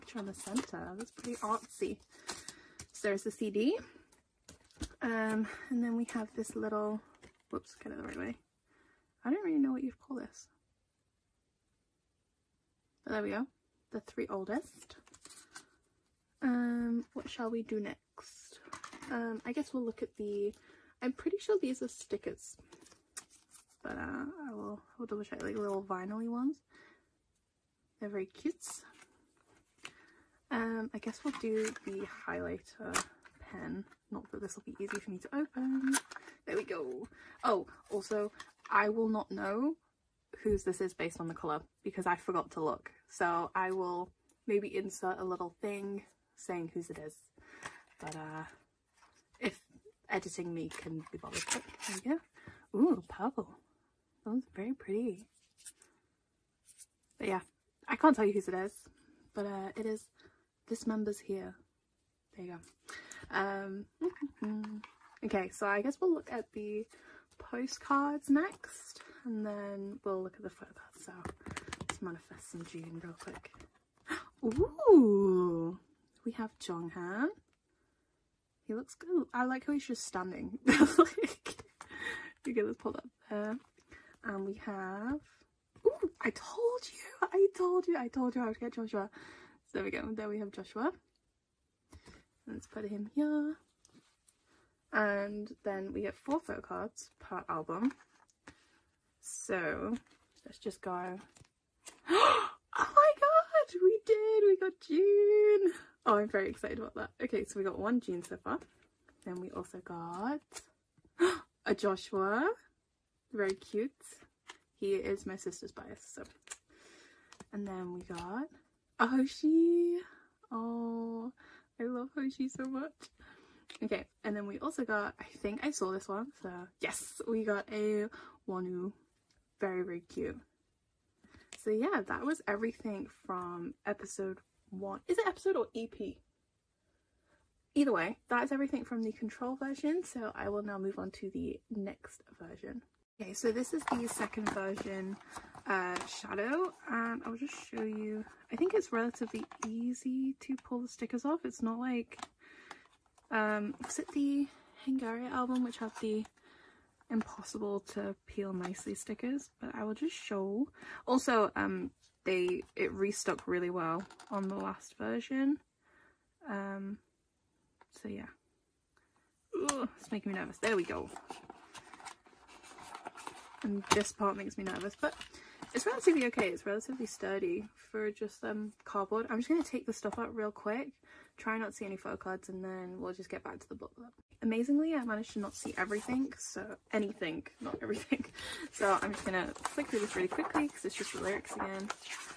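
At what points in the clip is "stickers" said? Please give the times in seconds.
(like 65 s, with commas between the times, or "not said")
21 s, 150 s, 158 s.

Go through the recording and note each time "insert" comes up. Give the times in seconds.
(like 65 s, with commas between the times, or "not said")
44 s.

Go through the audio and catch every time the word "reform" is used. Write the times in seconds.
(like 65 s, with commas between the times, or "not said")
not said.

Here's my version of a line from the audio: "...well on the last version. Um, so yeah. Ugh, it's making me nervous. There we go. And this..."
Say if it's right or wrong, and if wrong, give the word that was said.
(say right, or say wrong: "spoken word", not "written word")
right.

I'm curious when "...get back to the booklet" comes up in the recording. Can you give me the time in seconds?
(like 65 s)
183 s.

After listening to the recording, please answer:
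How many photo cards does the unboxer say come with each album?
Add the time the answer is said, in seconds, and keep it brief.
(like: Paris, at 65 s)
4, at 96 s.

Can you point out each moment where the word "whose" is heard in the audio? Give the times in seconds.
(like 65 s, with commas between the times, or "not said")
40 s, 46 s, 58 s.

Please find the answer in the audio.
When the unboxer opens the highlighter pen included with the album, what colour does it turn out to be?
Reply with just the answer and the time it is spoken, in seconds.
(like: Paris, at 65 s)
Purple, at 53 s.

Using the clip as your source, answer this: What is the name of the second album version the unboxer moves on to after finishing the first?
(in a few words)
Shadow.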